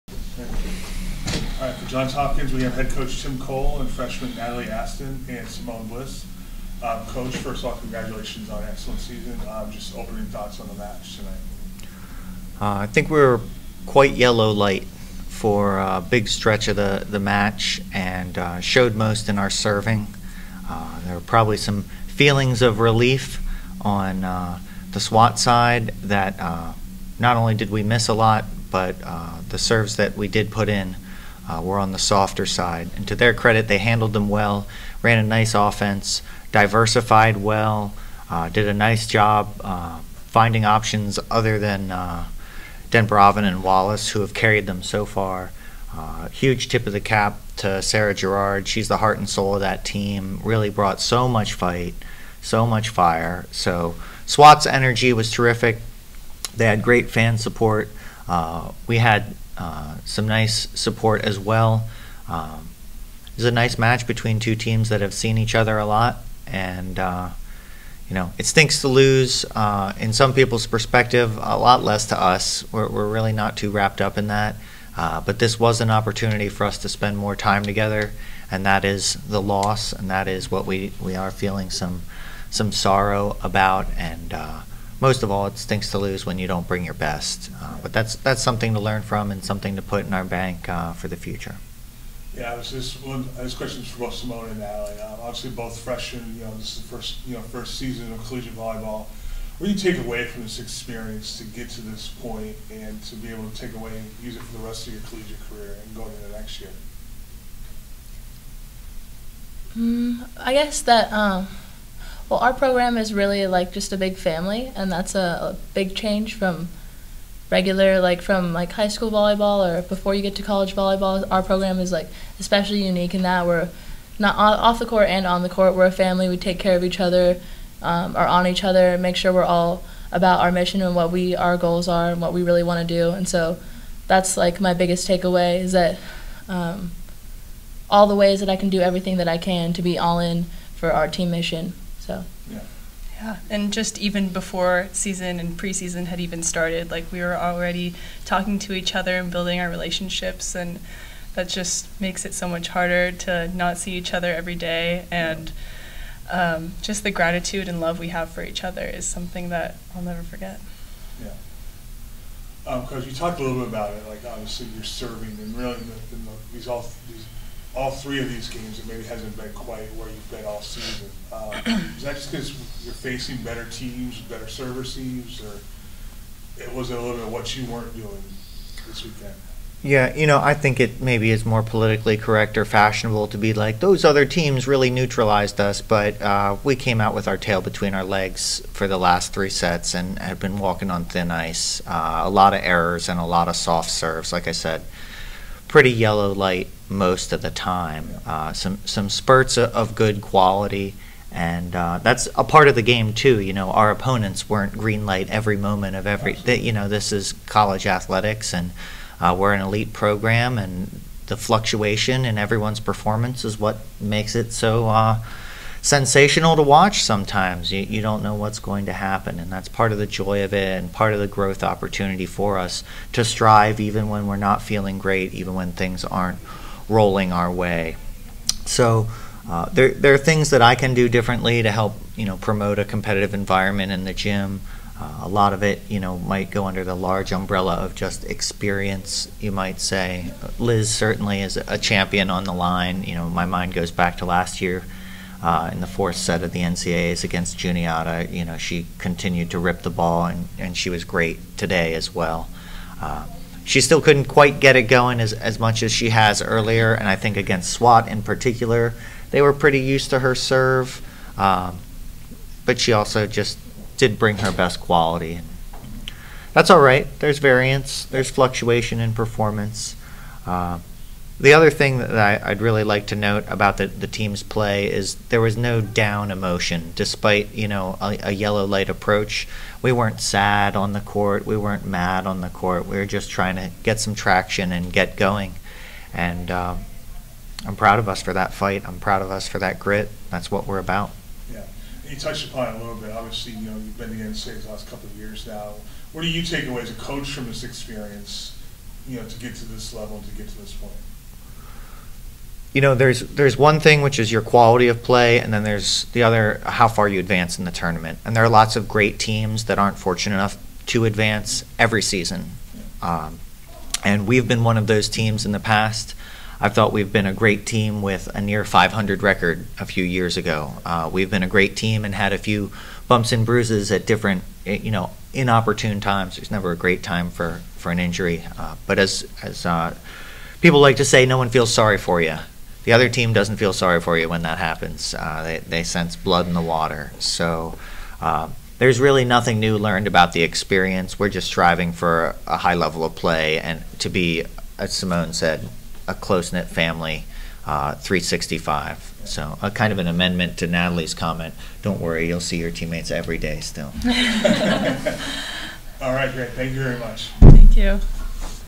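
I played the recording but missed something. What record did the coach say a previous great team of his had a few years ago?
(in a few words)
near 500.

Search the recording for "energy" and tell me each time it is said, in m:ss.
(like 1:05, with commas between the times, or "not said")
0:54.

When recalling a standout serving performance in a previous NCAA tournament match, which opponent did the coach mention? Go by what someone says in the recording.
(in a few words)
Juniata.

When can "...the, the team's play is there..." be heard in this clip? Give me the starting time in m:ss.
4:33.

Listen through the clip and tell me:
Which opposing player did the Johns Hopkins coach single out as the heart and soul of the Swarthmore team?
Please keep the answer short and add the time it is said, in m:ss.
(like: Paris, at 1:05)
Sarah Gerard, at 0:47.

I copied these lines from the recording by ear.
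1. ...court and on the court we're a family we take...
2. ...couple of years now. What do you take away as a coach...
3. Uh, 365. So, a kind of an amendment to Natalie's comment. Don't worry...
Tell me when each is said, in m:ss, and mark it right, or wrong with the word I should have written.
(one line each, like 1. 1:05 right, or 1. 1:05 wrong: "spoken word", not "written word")
1. 2:04 right
2. 4:54 right
3. 5:47 right.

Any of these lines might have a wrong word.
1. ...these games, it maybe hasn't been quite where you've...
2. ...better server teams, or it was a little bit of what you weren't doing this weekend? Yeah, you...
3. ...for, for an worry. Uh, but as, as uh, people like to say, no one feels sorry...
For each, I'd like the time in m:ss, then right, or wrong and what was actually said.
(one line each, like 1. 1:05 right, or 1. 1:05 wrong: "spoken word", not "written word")
1. 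2:48 right
2. 2:54 right
3. 5:27 wrong: "injury", not "worry".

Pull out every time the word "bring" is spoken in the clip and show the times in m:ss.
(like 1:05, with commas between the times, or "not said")
1:26, 4:24.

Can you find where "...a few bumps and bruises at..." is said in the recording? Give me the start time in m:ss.
5:22.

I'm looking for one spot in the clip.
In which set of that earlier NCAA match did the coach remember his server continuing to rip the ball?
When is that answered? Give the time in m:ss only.
4:05.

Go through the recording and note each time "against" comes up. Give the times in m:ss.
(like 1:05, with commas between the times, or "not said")
4:07, 4:17.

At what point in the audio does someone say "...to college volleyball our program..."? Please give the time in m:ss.
2:00.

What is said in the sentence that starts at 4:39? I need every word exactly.
We weren't sad on the court.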